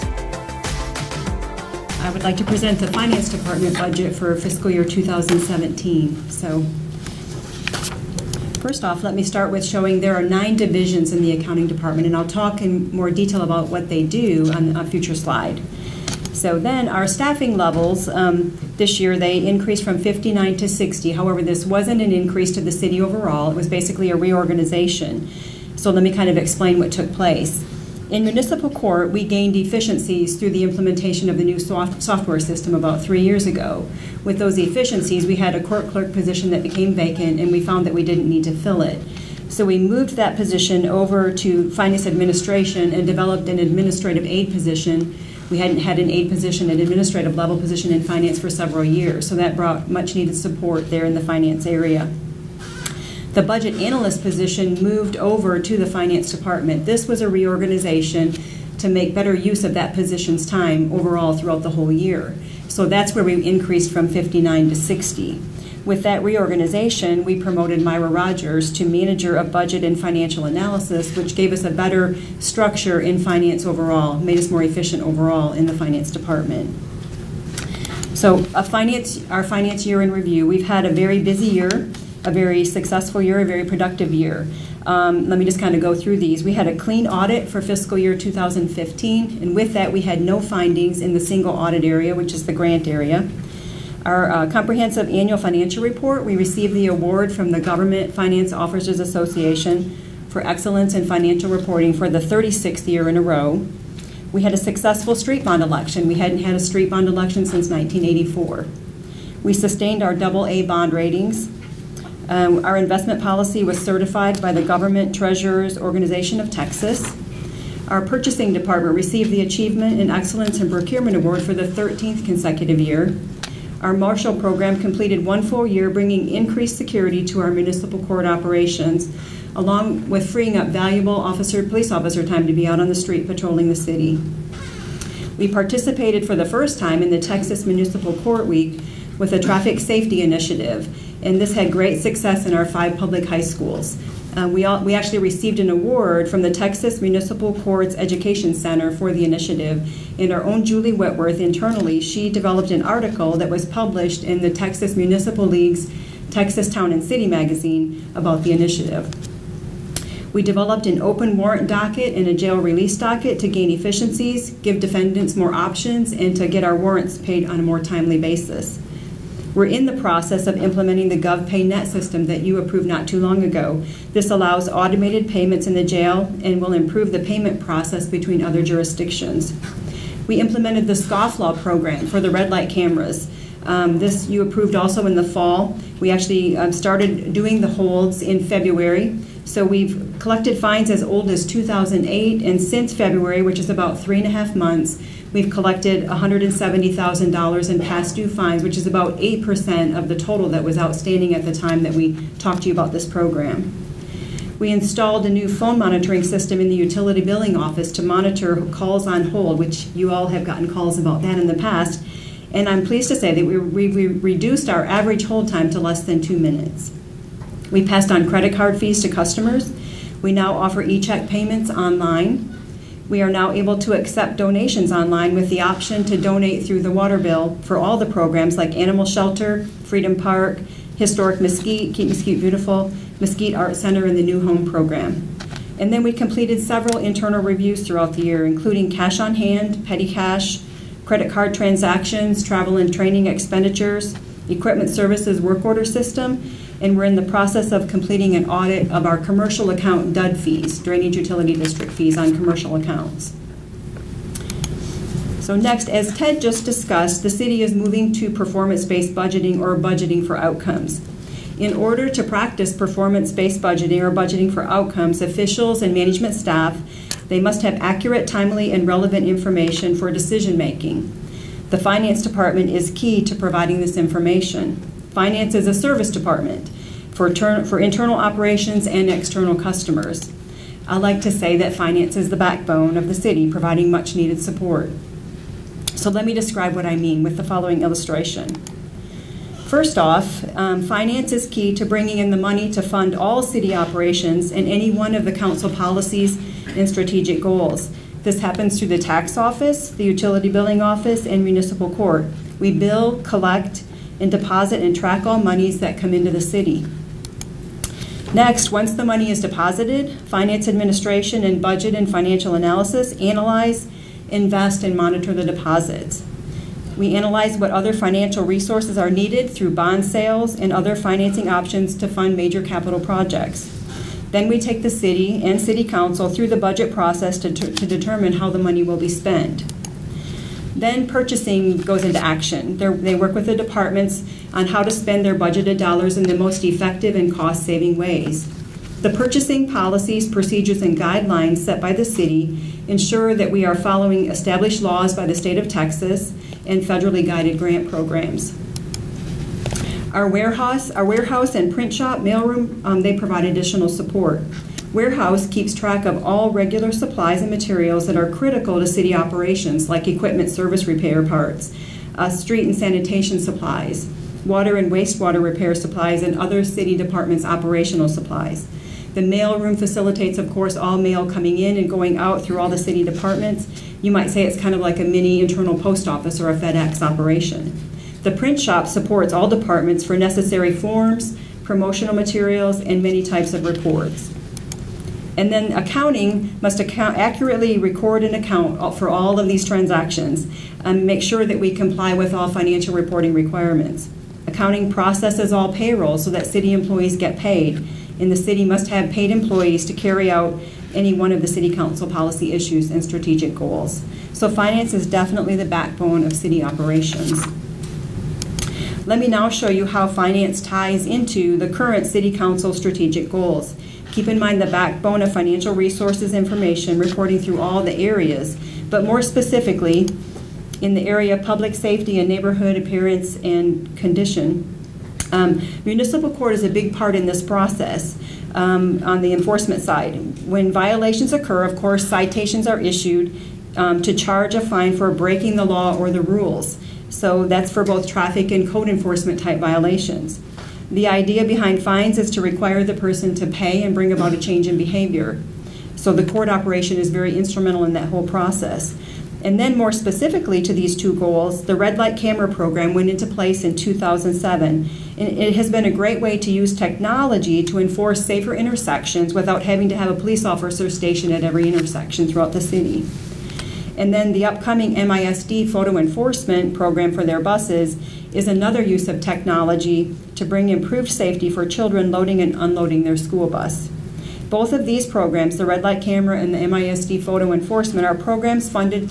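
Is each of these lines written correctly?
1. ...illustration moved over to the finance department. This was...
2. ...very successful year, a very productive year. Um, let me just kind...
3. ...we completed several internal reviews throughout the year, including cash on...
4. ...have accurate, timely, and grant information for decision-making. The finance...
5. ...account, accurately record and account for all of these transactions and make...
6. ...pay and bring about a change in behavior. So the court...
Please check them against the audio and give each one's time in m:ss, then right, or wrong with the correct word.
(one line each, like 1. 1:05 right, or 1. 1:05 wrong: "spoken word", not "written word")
1. 0:54 wrong: "position", not "illustration"
2. 1:22 right
3. 3:56 right
4. 4:27 wrong: "relevant", not "grant"
5. 6:26 right
6. 7:23 right.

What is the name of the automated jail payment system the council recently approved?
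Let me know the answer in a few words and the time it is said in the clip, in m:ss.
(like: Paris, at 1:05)
GovPayNet, at 2:51.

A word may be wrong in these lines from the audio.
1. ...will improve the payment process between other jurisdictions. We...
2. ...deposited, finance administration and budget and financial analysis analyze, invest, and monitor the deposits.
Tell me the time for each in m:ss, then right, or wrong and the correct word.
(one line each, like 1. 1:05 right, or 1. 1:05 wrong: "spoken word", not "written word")
1. 2:56 right
2. 5:09 right.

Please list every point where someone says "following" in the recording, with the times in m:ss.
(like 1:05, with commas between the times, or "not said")
4:47, 5:43.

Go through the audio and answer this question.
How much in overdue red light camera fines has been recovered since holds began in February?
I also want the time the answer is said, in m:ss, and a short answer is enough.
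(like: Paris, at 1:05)
$170,000, at 3:16.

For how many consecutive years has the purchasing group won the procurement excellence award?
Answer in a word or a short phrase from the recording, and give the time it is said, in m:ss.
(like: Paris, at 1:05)
13, at 2:01.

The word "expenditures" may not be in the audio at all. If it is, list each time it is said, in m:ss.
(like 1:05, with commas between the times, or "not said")
4:03.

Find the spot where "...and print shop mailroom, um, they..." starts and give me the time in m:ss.
5:51.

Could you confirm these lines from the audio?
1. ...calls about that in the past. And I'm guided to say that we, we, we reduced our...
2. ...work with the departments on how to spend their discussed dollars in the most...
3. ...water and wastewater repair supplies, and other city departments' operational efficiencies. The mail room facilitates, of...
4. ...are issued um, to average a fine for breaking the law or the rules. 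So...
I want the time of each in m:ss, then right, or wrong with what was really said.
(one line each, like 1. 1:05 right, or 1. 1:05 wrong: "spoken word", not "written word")
1. 3:30 wrong: "pleased", not "guided"
2. 5:33 wrong: "budgeted", not "discussed"
3. 6:04 wrong: "supplies", not "efficiencies"
4. 7:12 wrong: "charge", not "average".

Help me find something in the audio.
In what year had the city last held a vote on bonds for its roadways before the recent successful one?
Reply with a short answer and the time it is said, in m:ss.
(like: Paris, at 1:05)
1984, at 1:47.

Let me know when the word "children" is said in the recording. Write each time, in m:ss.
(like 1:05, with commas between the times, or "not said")
7:51.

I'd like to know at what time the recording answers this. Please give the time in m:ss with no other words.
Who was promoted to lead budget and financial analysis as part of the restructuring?
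1:07.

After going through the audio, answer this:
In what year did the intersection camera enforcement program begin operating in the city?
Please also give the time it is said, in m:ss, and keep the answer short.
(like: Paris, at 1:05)
2007, at 7:33.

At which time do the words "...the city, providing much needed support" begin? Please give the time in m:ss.
4:43.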